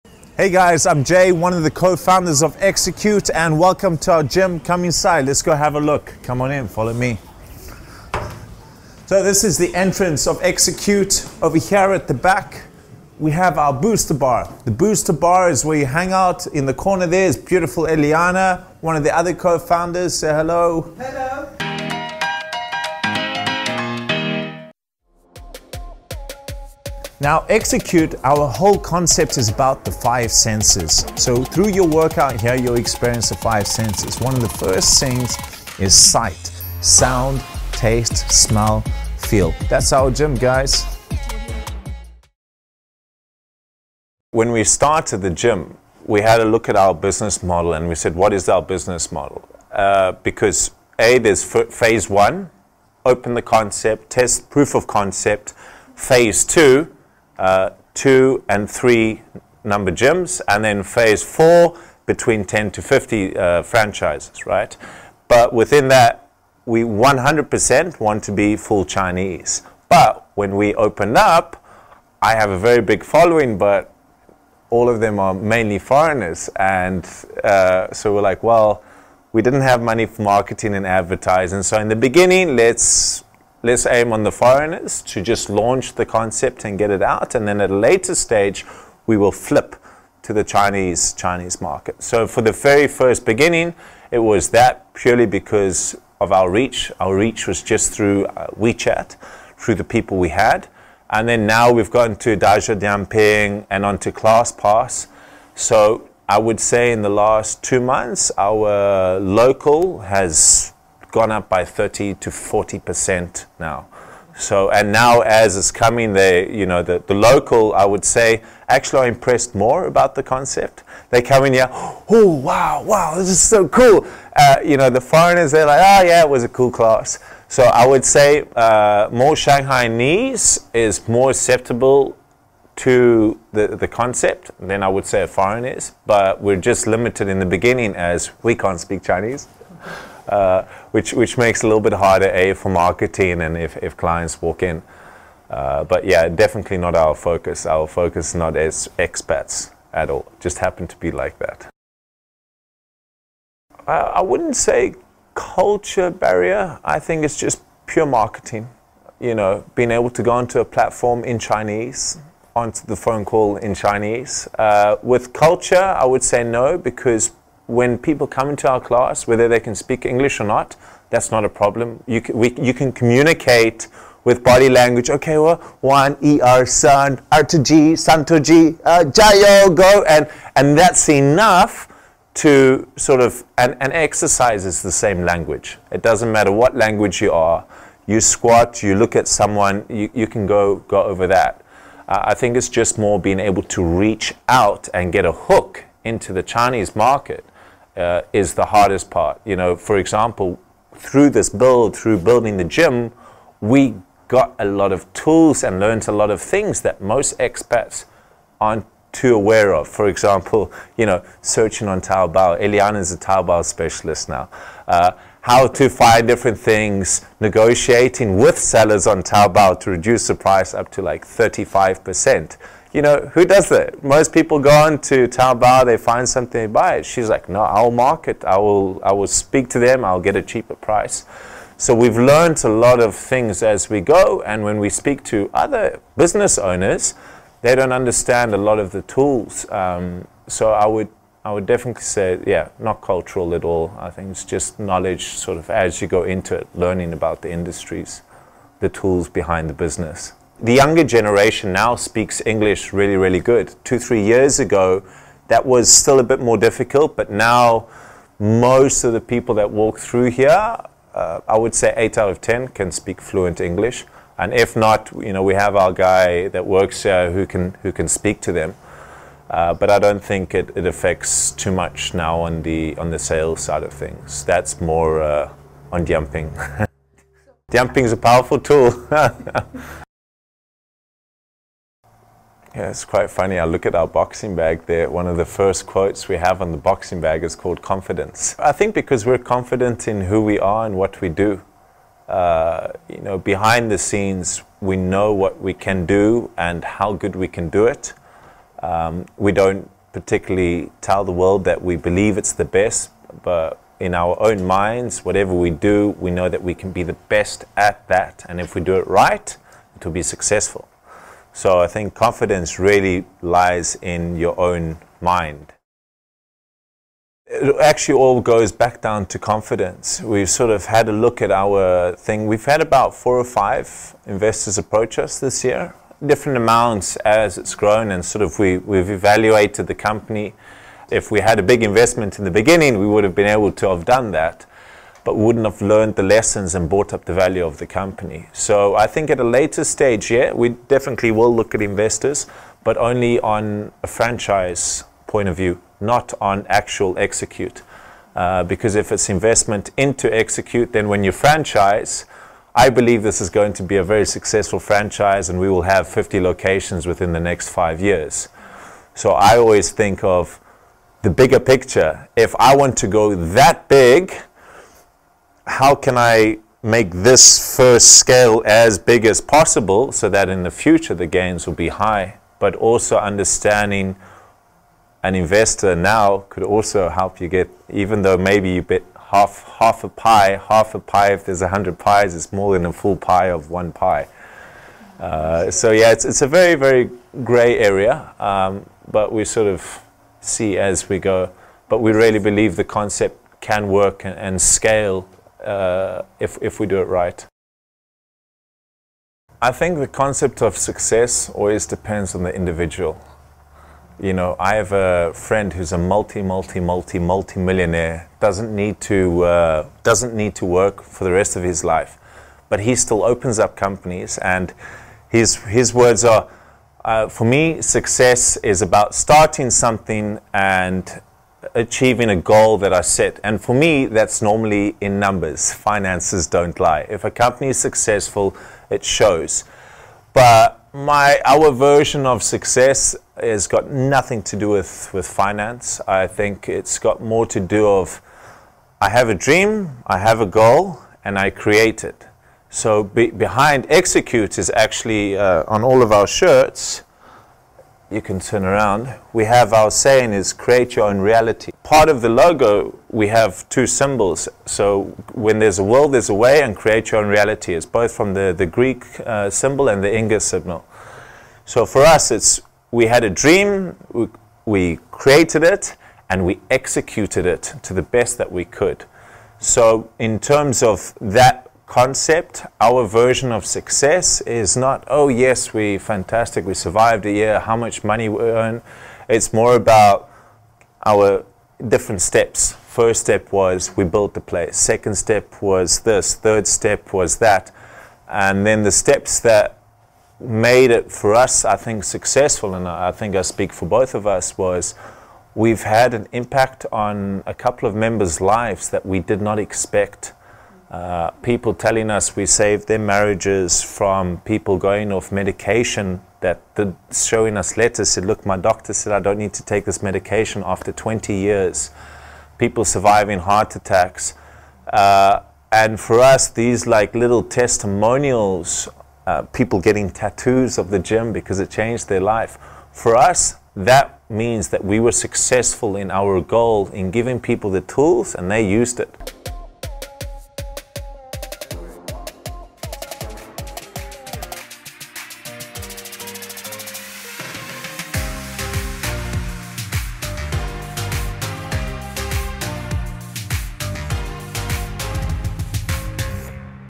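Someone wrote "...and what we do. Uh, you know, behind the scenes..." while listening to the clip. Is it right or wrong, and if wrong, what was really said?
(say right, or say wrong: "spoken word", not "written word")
right.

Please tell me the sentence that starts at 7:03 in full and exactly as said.
And for me, that's normally in numbers.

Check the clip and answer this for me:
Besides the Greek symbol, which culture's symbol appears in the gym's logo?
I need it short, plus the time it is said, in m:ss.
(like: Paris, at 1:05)
Inca, at 7:40.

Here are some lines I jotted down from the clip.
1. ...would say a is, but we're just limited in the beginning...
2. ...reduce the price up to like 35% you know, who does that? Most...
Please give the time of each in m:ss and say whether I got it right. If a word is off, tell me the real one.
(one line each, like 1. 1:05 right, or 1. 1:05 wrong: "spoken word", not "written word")
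1. 2:14 right
2. 3:39 right.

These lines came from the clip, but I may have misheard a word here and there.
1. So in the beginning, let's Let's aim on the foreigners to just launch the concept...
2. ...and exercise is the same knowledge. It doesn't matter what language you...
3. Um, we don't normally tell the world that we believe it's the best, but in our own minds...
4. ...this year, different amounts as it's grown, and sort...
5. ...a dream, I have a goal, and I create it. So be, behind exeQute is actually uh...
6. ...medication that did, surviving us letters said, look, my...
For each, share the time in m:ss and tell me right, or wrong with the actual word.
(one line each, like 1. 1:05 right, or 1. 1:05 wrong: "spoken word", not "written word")
1. 1:21 right
2. 3:03 wrong: "language", not "knowledge"
3. 4:58 wrong: "particularly", not "normally"
4. 5:25 right
5. 7:19 right
6. 8:25 wrong: "showing", not "surviving".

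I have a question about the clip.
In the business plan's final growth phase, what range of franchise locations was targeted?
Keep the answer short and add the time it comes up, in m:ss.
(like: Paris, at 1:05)
10 to 50, at 1:02.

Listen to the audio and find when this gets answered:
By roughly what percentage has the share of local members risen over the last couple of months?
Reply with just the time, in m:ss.
1:51.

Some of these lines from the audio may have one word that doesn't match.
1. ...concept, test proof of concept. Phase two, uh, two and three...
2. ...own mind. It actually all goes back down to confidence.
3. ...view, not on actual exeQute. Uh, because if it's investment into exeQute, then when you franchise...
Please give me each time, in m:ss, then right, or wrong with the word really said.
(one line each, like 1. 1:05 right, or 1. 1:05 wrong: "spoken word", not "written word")
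1. 0:53 right
2. 5:14 right
3. 5:45 right.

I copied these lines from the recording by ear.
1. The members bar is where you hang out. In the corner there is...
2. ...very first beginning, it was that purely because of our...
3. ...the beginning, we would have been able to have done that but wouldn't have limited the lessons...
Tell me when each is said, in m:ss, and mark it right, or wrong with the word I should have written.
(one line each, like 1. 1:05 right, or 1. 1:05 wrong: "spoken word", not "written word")
1. 0:14 wrong: "booster", not "members"
2. 1:32 right
3. 5:32 wrong: "learned", not "limited".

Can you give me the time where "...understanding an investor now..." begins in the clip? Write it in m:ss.
6:13.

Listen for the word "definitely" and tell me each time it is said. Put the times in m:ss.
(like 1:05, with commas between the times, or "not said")
2:26, 4:01, 5:40.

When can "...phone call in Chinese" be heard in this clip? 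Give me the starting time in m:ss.
2:42.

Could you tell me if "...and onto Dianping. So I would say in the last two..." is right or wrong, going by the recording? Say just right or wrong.
wrong.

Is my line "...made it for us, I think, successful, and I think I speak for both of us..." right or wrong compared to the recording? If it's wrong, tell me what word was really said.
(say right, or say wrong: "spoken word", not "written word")
right.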